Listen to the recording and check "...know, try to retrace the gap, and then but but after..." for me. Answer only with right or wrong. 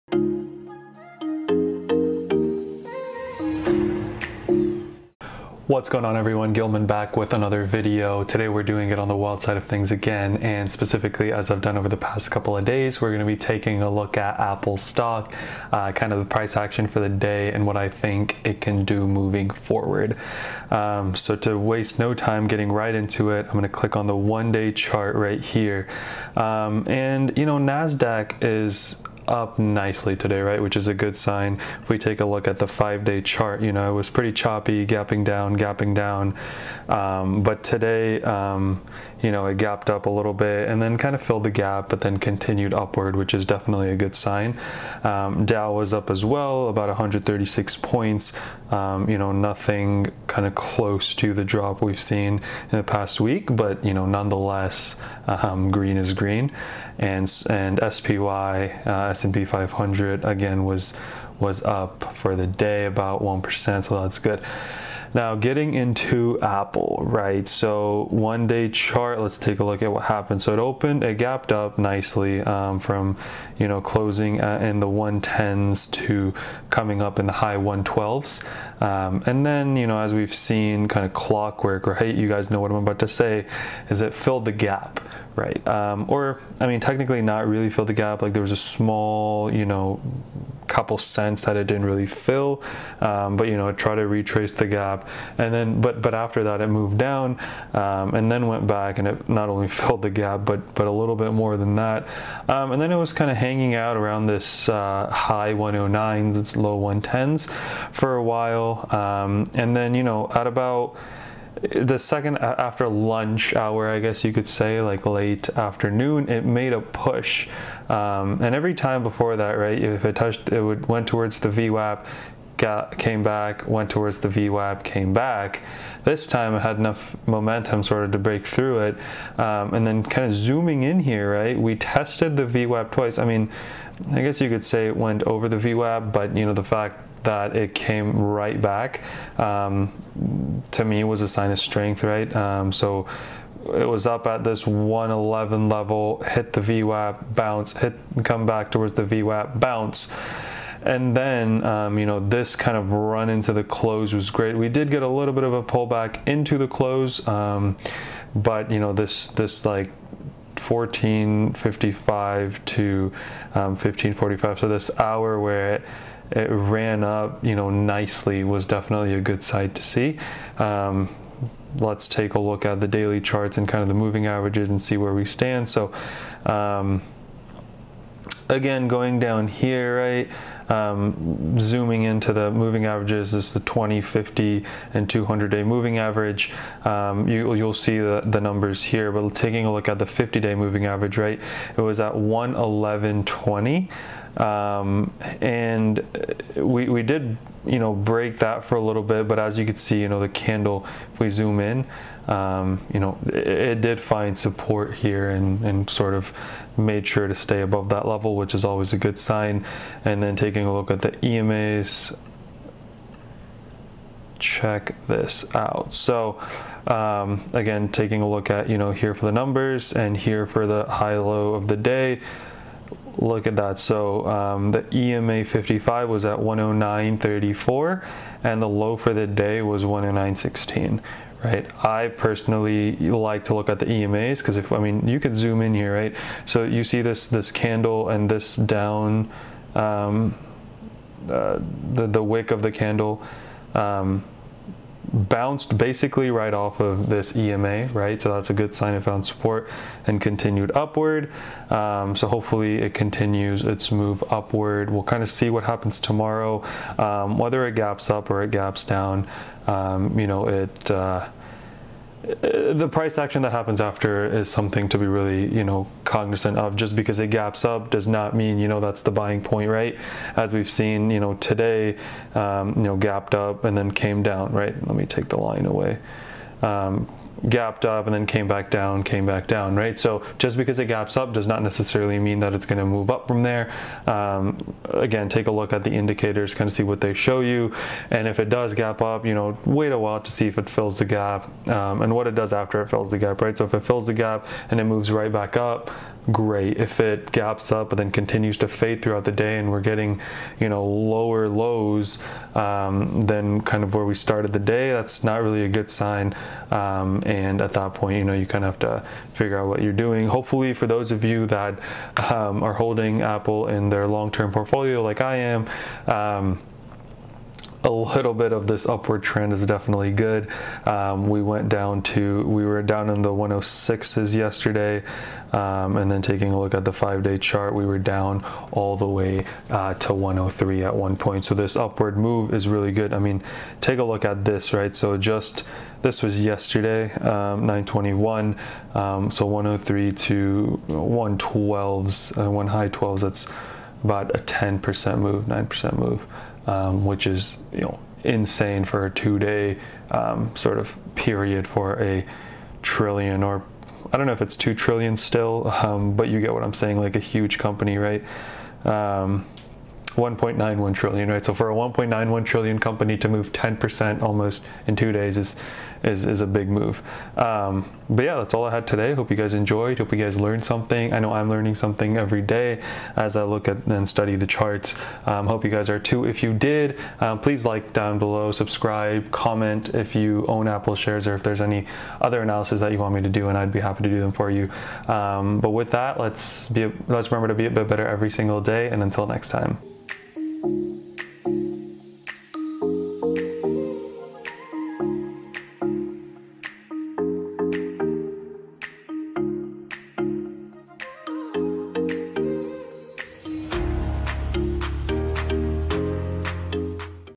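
right.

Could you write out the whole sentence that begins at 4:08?
So that's a good sign it found support and continued upward.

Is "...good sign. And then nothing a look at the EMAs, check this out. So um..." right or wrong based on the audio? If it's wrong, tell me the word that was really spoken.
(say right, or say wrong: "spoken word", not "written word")
wrong: "taking", not "nothing".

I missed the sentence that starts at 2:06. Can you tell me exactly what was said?
This time it had enough momentum sort of to break through it.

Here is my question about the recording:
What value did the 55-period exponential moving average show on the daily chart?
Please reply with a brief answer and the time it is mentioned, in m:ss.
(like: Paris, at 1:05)
109.34, at 3:46.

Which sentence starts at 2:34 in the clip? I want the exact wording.
We did get a little bit of a pullback into the close, um, but, you know, this, this like 1455 to 1545.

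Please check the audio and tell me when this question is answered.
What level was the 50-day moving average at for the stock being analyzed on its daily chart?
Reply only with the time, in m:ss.
3:12.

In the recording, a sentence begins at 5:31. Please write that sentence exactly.
So this upward move is really good.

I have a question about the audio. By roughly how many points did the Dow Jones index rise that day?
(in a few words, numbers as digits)
136.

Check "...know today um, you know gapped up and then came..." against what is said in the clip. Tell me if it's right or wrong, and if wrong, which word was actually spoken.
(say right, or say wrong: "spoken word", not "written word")
right.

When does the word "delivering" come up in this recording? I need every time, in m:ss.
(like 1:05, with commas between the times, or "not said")
not said.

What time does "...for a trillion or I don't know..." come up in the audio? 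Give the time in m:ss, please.
5:51.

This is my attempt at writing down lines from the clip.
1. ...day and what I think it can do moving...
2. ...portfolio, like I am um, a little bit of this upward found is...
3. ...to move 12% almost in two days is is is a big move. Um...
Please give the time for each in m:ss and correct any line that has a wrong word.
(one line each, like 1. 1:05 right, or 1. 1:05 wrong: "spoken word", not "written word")
1. 0:17 right
2. 5:14 wrong: "trend", not "found"
3. 6:03 wrong: "10", not "12".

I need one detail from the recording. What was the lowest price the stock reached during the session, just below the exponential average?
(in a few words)
109.16.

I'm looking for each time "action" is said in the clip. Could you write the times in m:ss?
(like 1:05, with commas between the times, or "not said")
0:16, 4:23.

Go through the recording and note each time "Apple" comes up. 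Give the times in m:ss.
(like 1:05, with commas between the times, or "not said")
0:14, 1:06, 5:13, 6:20.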